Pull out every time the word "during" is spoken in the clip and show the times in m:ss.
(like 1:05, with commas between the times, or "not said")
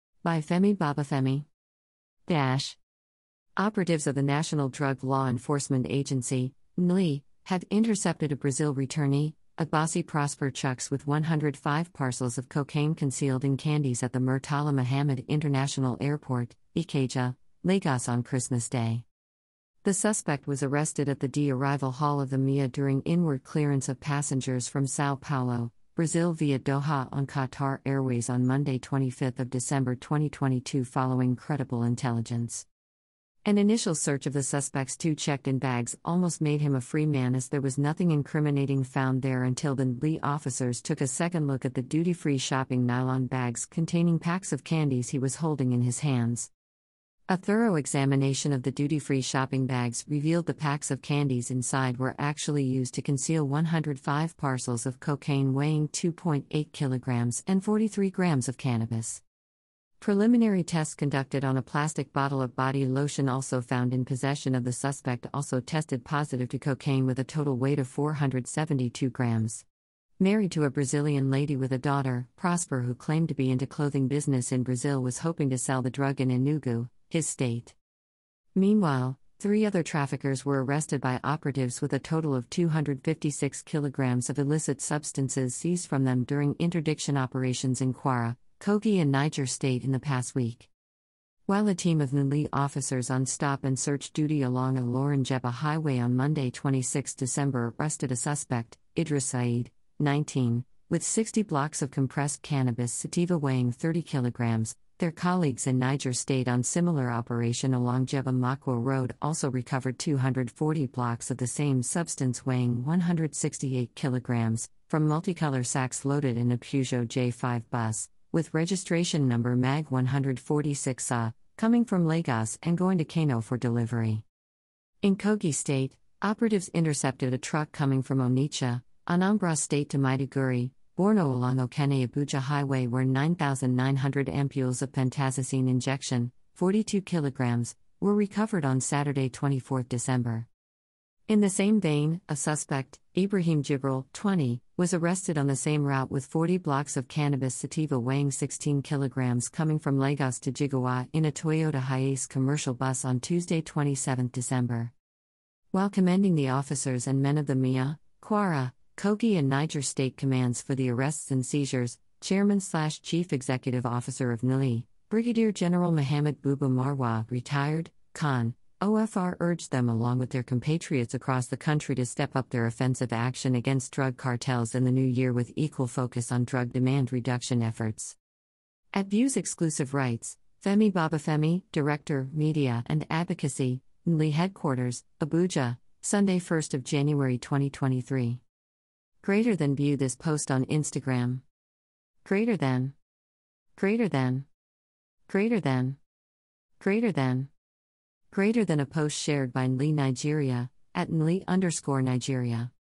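0:22, 1:26.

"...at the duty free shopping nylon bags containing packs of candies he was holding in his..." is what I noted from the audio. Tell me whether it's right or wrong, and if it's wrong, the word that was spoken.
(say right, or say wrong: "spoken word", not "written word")
right.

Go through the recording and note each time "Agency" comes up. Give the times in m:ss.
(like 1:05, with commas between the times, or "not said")
0:05.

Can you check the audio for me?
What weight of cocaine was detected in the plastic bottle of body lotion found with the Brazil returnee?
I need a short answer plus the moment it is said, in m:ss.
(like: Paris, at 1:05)
472 grams, at 1:07.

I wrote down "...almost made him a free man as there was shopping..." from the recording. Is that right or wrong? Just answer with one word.
wrong.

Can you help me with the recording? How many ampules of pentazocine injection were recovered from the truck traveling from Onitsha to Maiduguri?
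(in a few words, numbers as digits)
9,900.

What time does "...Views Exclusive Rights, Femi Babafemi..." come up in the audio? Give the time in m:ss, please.
2:59.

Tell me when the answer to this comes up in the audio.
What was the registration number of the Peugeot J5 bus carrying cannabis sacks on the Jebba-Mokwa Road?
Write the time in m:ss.
1:59.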